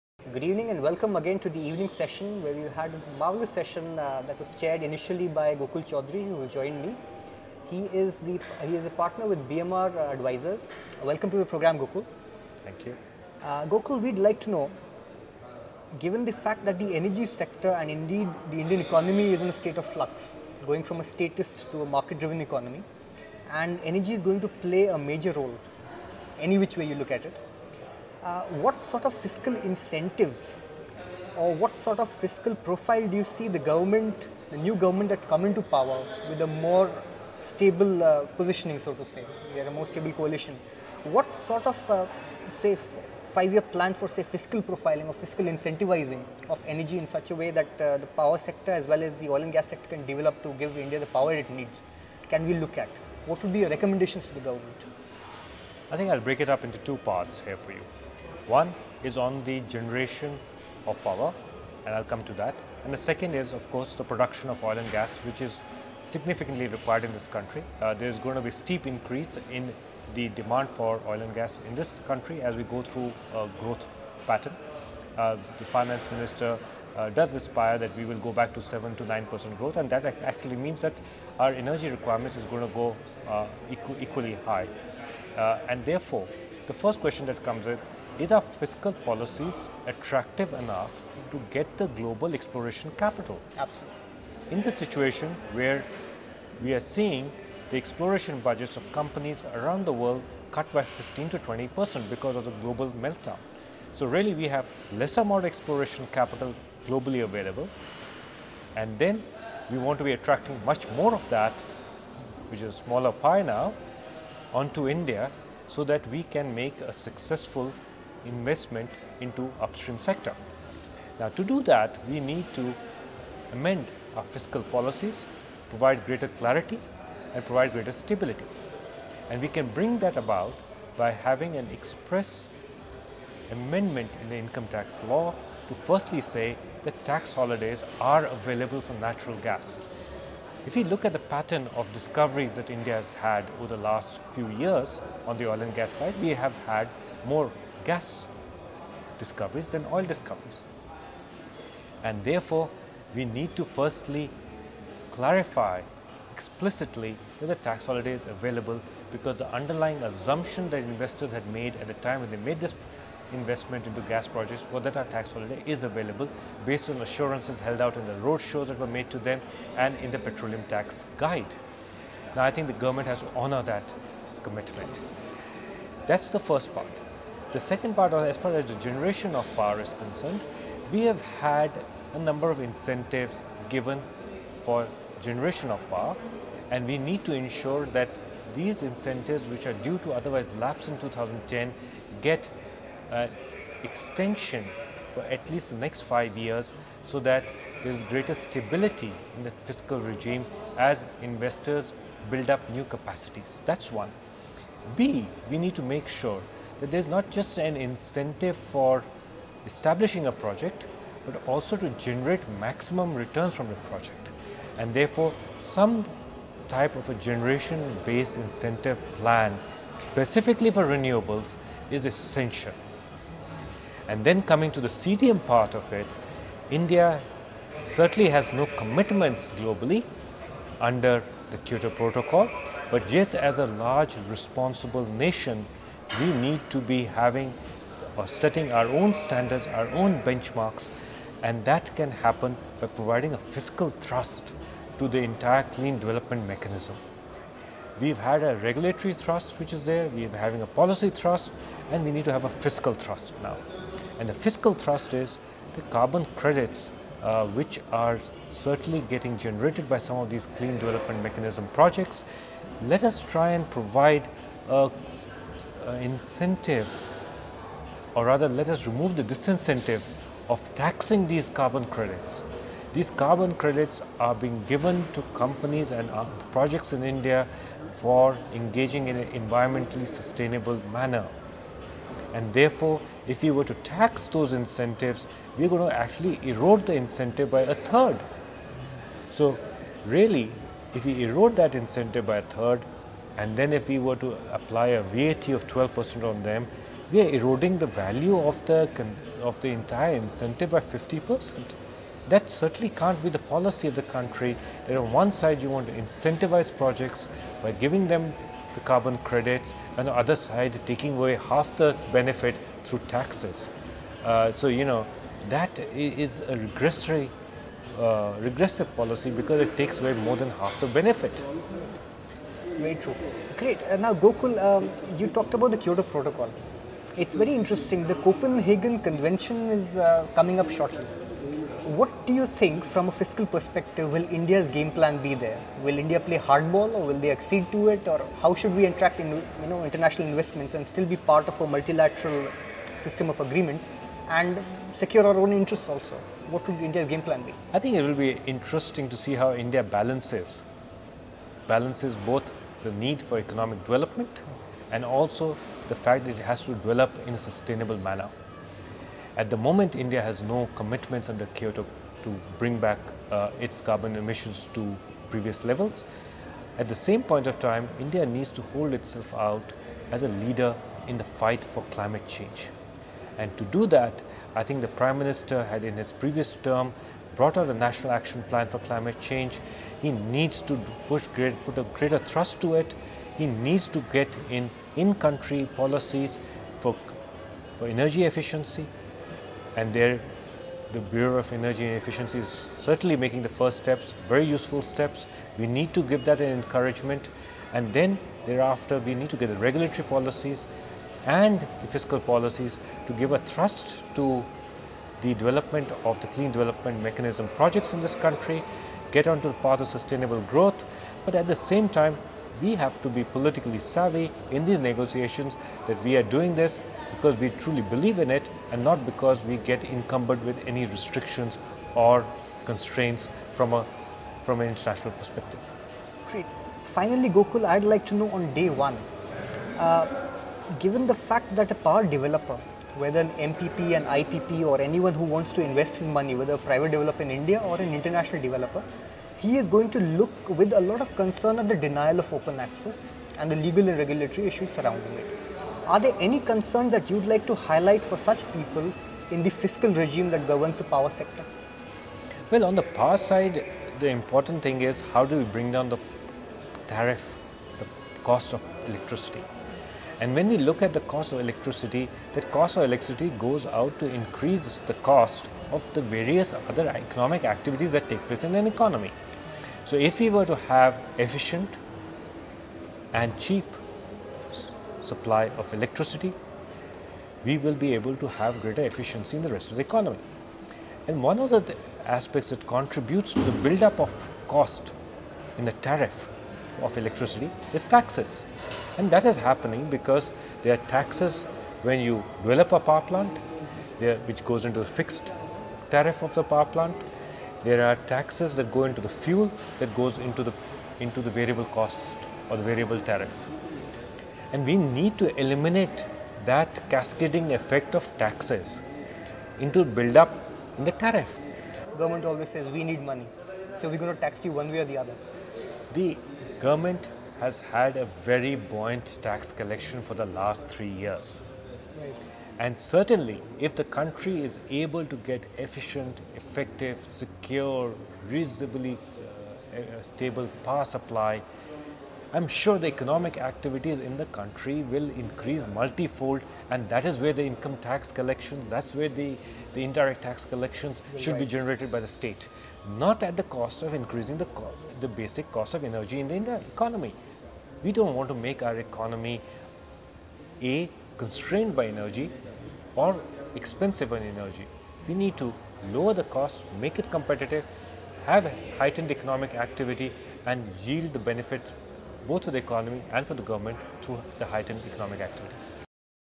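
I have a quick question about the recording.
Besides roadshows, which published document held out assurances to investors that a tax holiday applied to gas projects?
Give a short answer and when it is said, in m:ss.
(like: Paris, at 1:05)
petroleum tax guide, at 2:50.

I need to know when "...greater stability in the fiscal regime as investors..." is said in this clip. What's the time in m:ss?
3:18.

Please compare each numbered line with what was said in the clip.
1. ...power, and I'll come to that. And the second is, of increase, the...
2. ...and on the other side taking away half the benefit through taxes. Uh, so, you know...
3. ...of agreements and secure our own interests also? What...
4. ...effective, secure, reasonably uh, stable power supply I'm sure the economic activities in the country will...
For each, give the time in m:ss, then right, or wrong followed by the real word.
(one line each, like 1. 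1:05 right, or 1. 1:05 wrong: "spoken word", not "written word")
1. 1:01 wrong: "course", not "increase"
2. 5:09 right
3. 5:43 right
4. 8:46 right.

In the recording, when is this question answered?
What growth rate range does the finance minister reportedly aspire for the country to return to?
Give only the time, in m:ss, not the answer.
1:18.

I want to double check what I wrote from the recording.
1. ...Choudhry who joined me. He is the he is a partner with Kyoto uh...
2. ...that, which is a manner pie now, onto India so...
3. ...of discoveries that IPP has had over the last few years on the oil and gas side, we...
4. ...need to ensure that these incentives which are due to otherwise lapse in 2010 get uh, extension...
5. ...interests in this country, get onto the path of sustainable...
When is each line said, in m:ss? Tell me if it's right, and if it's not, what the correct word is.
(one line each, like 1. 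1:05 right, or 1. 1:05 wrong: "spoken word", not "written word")
1. 0:05 wrong: "BMR", not "Kyoto"
2. 1:51 wrong: "smaller", not "manner"
3. 2:21 wrong: "India", not "IPP"
4. 3:06 right
5. 6:47 wrong: "projects", not "interests".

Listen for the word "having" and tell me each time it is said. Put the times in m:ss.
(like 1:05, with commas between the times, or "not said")
2:11, 3:57, 4:10.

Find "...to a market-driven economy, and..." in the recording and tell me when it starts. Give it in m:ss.
0:21.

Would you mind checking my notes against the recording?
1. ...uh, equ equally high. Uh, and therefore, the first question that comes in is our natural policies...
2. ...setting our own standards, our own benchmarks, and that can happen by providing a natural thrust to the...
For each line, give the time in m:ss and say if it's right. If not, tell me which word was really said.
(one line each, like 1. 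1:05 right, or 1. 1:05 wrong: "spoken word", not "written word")
1. 1:23 wrong: "fiscal", not "natural"
2. 3:58 wrong: "fiscal", not "natural".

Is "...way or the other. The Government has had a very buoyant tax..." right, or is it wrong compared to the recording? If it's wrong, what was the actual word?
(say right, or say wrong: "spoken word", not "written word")
right.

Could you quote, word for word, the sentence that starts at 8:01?
And one of the aspects that contributes to the buildup of cost in the tariff of electricity is taxes.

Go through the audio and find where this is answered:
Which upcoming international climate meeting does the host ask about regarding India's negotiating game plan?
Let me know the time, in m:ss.
5:28.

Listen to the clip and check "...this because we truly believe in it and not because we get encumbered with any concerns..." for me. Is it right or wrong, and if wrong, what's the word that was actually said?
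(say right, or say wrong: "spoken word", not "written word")
wrong: "restrictions", not "concerns".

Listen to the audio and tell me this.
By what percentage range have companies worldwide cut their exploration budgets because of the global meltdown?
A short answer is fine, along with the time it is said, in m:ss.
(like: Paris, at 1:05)
15 to 20 percent, at 1:40.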